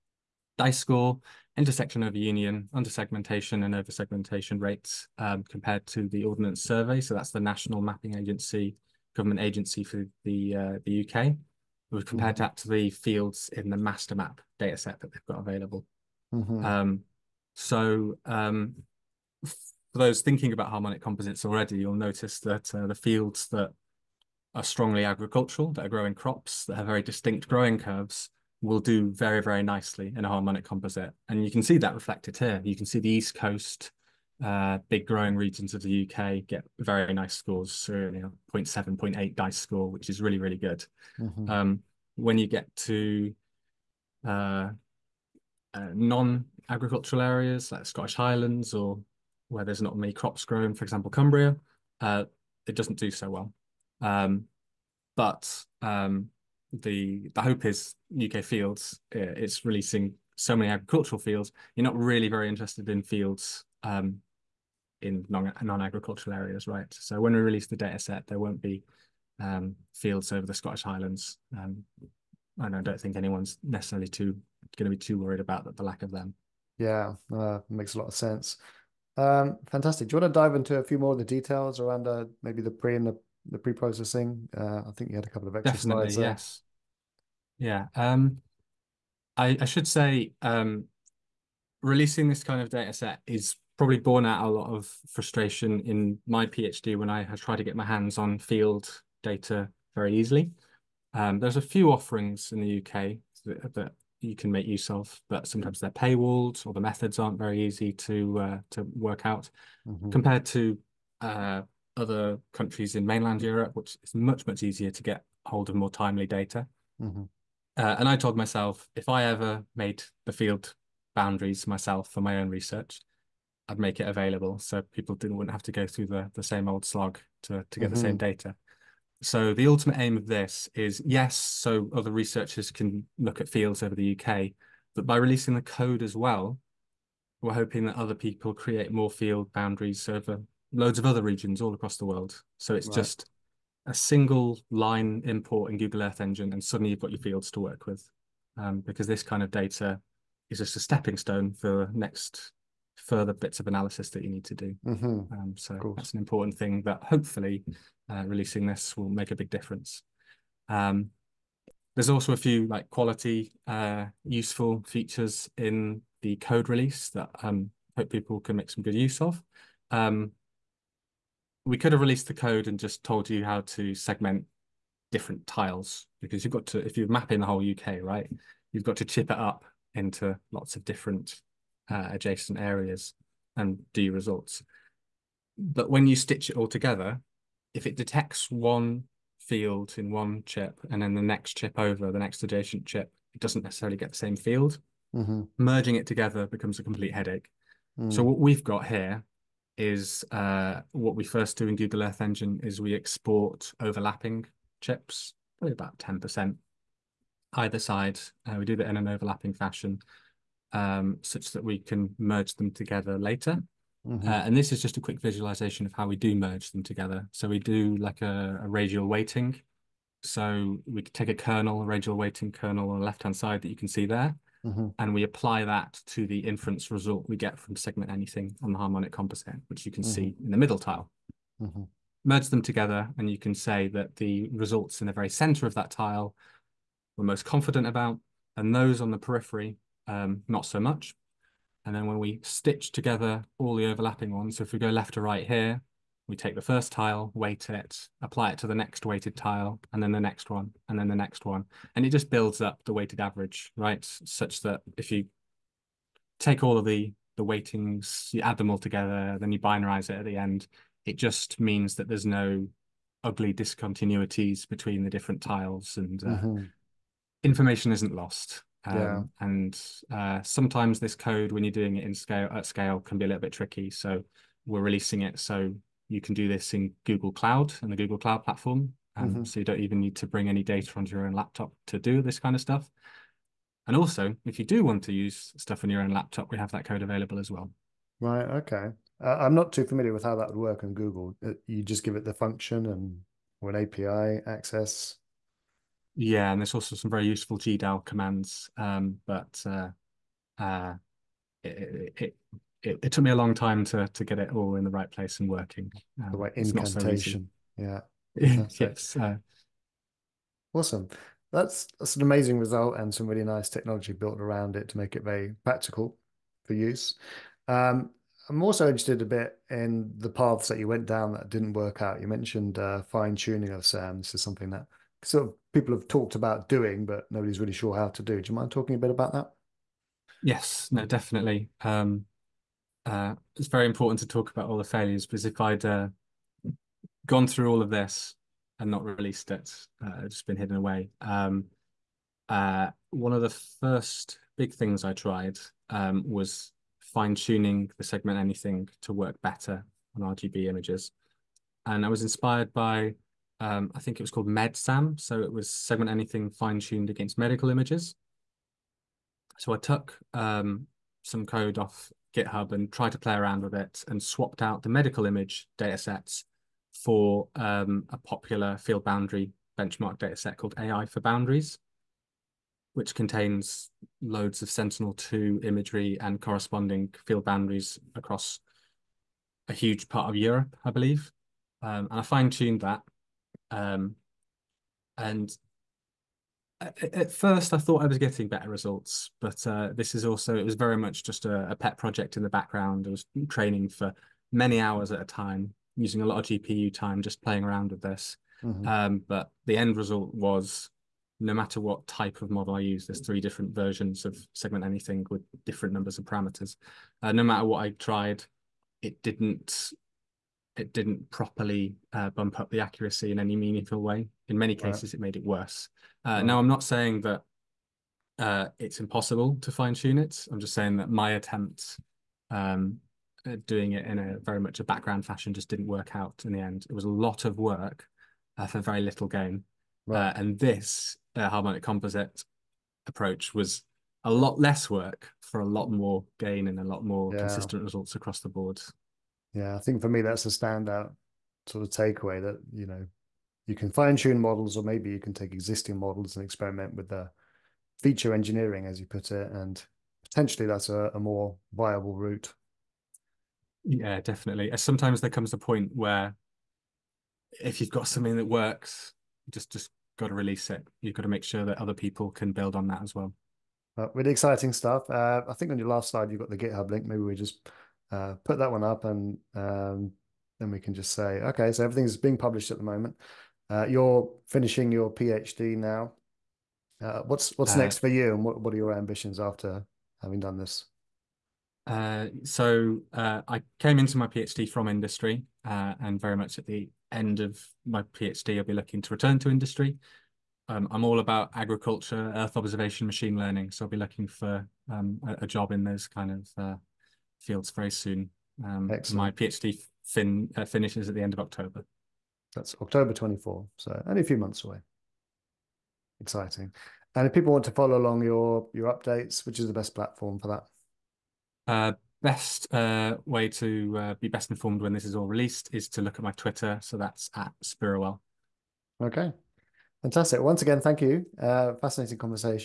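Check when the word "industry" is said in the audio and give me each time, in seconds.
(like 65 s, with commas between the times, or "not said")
484 s, 489 s.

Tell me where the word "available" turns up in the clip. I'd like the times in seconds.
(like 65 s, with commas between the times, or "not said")
15 s, 124 s, 287 s.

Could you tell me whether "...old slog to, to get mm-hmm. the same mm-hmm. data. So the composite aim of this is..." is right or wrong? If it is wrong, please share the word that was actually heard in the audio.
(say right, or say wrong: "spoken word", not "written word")
wrong: "ultimate", not "composite".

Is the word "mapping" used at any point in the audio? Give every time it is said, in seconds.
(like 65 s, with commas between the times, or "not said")
7 s, 177 s.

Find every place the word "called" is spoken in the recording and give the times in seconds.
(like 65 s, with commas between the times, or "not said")
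354 s, 370 s.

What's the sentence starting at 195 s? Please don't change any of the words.
merging it together becomes a complete headache mm.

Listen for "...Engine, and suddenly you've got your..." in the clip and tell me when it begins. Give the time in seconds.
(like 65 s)
146 s.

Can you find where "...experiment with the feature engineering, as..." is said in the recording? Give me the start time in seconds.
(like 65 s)
446 s.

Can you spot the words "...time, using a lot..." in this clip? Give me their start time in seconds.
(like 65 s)
395 s.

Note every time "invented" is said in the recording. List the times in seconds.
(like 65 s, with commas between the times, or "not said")
not said.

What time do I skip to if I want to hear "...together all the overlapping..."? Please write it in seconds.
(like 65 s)
242 s.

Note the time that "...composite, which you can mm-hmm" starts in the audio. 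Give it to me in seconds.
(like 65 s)
229 s.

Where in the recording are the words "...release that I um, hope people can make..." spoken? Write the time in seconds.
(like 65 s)
166 s.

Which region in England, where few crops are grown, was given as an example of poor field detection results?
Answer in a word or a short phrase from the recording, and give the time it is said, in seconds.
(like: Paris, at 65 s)
Cumbria, at 51 s.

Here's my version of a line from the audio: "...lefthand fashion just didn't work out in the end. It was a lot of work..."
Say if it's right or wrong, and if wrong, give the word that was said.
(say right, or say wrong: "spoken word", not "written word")
wrong: "background", not "lefthand".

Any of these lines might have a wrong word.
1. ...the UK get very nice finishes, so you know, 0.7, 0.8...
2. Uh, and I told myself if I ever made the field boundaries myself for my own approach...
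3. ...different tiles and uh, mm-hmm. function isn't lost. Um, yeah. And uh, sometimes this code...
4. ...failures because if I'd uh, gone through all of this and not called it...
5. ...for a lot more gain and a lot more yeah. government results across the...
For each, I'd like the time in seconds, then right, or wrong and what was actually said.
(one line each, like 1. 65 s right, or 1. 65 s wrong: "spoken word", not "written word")
1. 35 s wrong: "scores", not "finishes"
2. 117 s wrong: "research", not "approach"
3. 265 s wrong: "information", not "function"
4. 334 s wrong: "released", not "called"
5. 435 s wrong: "consistent", not "government".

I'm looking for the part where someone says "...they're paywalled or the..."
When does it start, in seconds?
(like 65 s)
105 s.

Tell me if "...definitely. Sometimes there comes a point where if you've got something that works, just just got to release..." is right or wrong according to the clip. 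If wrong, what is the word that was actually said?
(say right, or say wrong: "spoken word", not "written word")
right.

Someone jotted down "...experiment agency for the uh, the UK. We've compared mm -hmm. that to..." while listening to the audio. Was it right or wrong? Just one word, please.
wrong.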